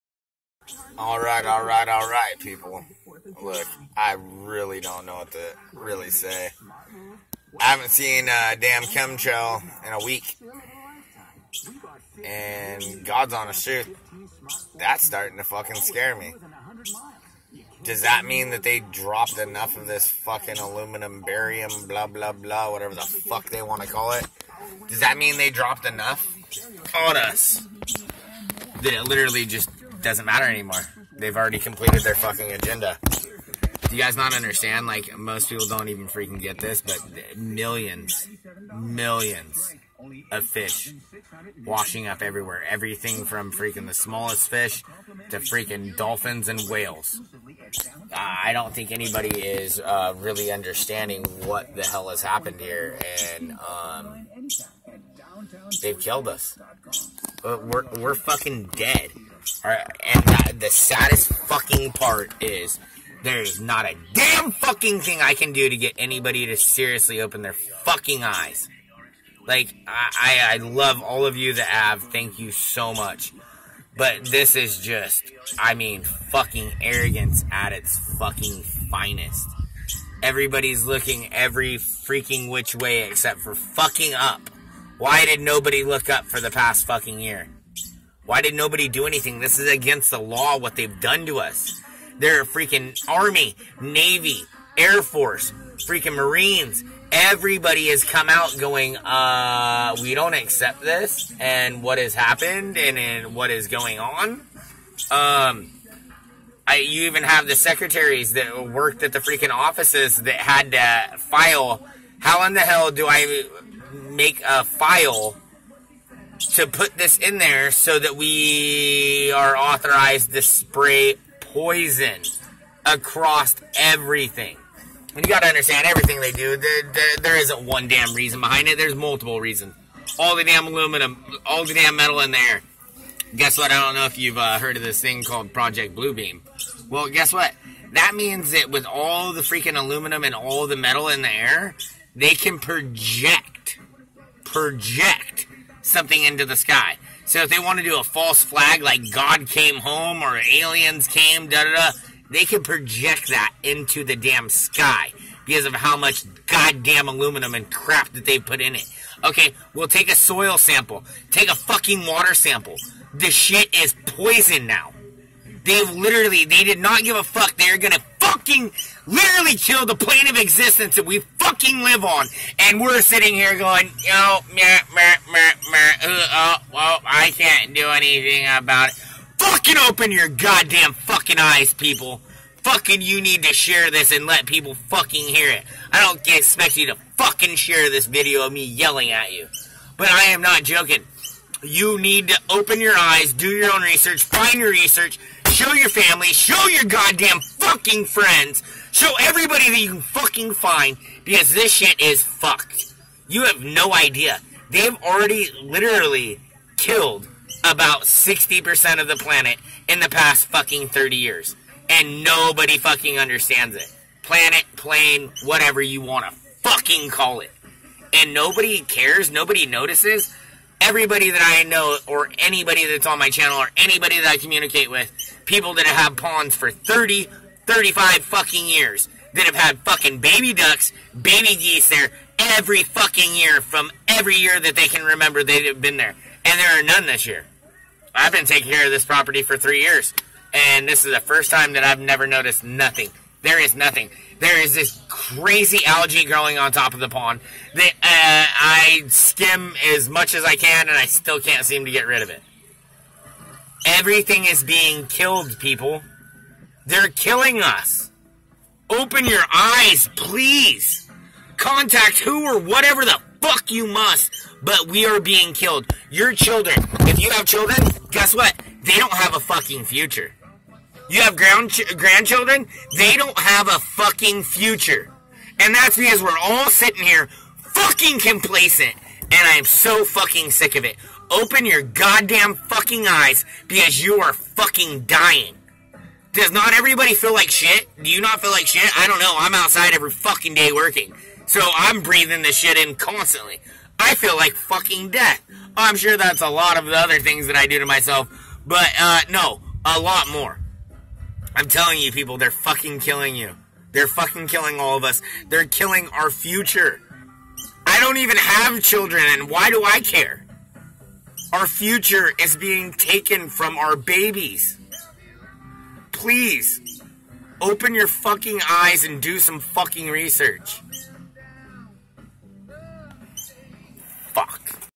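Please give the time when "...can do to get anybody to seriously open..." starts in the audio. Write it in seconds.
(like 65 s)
65 s.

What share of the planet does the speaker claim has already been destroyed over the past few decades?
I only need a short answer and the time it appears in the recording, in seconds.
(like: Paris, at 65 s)
60%, at 208 s.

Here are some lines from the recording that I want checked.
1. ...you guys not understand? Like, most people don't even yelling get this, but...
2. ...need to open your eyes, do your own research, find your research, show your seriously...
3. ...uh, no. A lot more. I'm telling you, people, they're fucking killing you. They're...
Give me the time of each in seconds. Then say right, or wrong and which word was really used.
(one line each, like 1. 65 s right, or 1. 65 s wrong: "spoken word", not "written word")
1. 33 s wrong: "freaking", not "yelling"
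2. 191 s wrong: "family", not "seriously"
3. 298 s right.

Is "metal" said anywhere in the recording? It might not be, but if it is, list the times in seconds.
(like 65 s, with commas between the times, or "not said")
131 s, 140 s.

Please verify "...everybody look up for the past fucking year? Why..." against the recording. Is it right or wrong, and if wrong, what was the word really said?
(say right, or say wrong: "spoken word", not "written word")
wrong: "nobody", not "everybody".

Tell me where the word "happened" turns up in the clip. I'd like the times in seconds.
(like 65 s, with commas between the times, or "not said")
52 s, 102 s.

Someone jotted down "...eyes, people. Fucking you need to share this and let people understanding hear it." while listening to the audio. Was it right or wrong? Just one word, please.
wrong.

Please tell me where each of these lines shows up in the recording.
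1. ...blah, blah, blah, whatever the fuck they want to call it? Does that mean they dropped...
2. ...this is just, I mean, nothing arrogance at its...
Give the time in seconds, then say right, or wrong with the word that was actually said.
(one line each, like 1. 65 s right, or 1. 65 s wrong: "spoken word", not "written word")
1. 21 s right
2. 74 s wrong: "fucking", not "nothing".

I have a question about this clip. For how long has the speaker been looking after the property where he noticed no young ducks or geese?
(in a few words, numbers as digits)
3 years.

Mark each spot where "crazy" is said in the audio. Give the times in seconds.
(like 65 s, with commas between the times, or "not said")
245 s.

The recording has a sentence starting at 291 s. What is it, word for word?
So I'm breathing this shit in constantly.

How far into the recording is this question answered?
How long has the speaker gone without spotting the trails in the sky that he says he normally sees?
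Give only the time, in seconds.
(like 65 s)
9 s.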